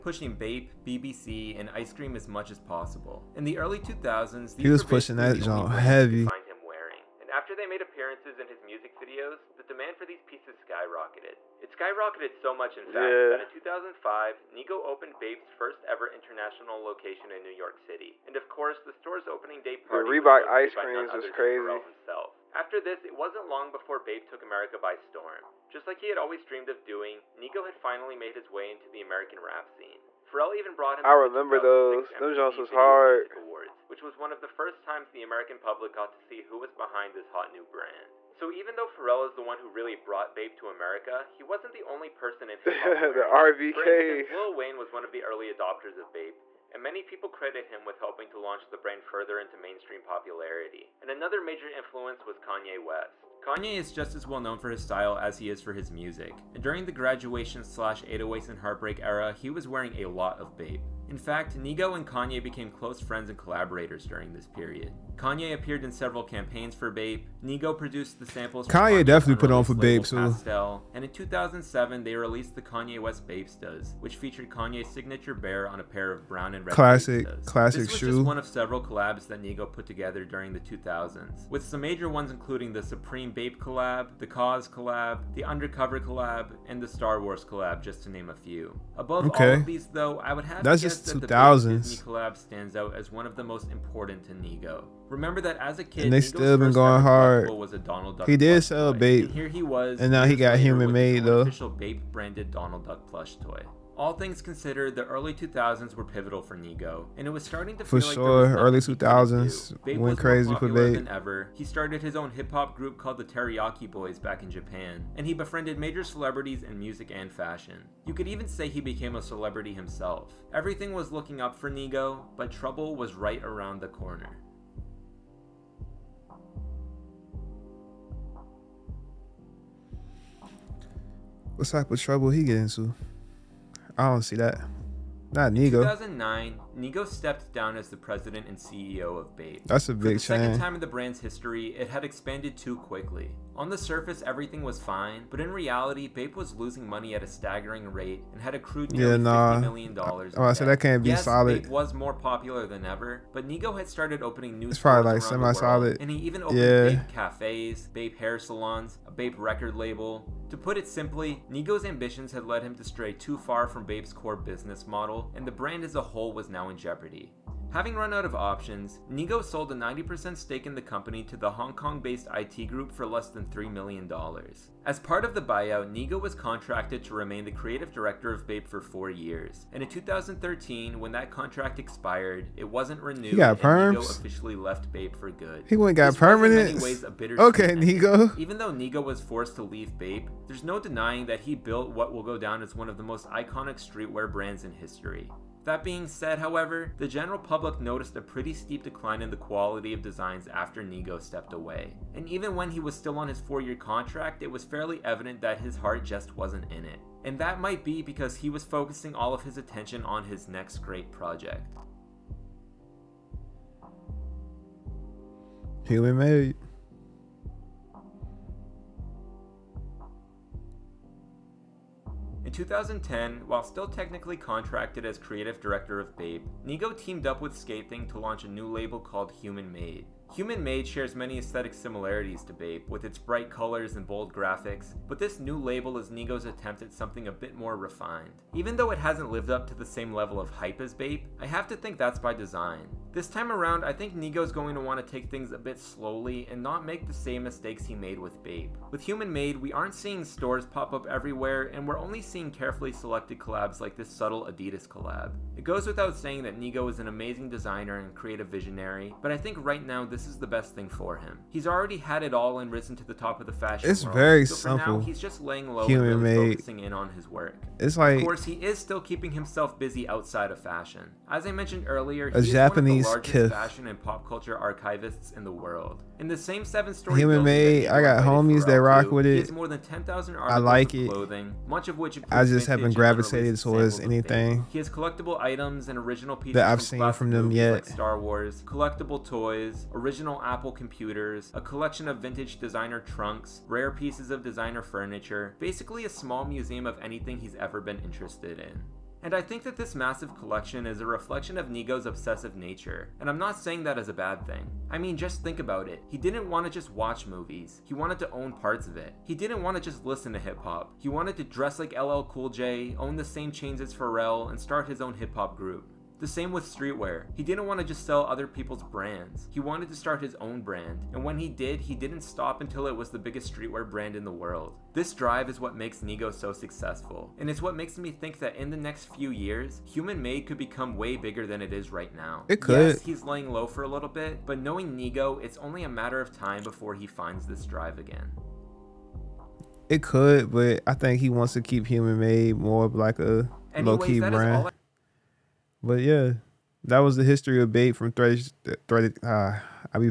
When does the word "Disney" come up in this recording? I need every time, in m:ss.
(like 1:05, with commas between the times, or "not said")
1:31.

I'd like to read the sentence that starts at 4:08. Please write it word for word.
With Human Made, we aren't seeing stores pop up everywhere, and we're only seeing carefully selected collabs like this subtle Adidas collab.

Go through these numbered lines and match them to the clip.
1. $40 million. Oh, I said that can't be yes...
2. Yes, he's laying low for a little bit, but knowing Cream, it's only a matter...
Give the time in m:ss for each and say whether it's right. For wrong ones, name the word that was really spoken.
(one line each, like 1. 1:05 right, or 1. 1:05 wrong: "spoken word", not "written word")
1. 2:29 wrong: "50", not "40"
2. 5:32 wrong: "Nigo", not "Cream".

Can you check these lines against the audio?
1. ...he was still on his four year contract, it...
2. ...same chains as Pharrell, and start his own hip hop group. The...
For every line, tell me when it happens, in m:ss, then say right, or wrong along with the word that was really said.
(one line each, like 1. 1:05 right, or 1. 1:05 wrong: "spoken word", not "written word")
1. 3:22 right
2. 5:13 right.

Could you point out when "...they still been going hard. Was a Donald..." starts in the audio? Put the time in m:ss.
1:36.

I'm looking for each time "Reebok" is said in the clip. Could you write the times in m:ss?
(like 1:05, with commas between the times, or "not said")
0:20.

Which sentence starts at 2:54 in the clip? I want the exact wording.
As part of the buyout, Nigo was contracted to remain the creative director of Bape for four years.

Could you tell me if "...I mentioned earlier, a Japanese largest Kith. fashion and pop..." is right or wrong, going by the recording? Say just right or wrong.
right.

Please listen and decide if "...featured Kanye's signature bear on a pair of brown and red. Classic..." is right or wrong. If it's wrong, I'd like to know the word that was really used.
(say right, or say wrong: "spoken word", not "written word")
right.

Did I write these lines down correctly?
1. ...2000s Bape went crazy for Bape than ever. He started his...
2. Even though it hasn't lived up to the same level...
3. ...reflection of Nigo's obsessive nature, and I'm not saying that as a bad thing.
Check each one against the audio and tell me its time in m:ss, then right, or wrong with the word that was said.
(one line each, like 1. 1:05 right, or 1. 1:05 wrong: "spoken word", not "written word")
1. 1:48 right
2. 3:58 right
3. 5:01 right.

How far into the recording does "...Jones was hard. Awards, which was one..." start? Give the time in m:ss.
0:32.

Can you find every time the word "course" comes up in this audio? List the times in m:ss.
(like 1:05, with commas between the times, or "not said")
0:18, 4:28.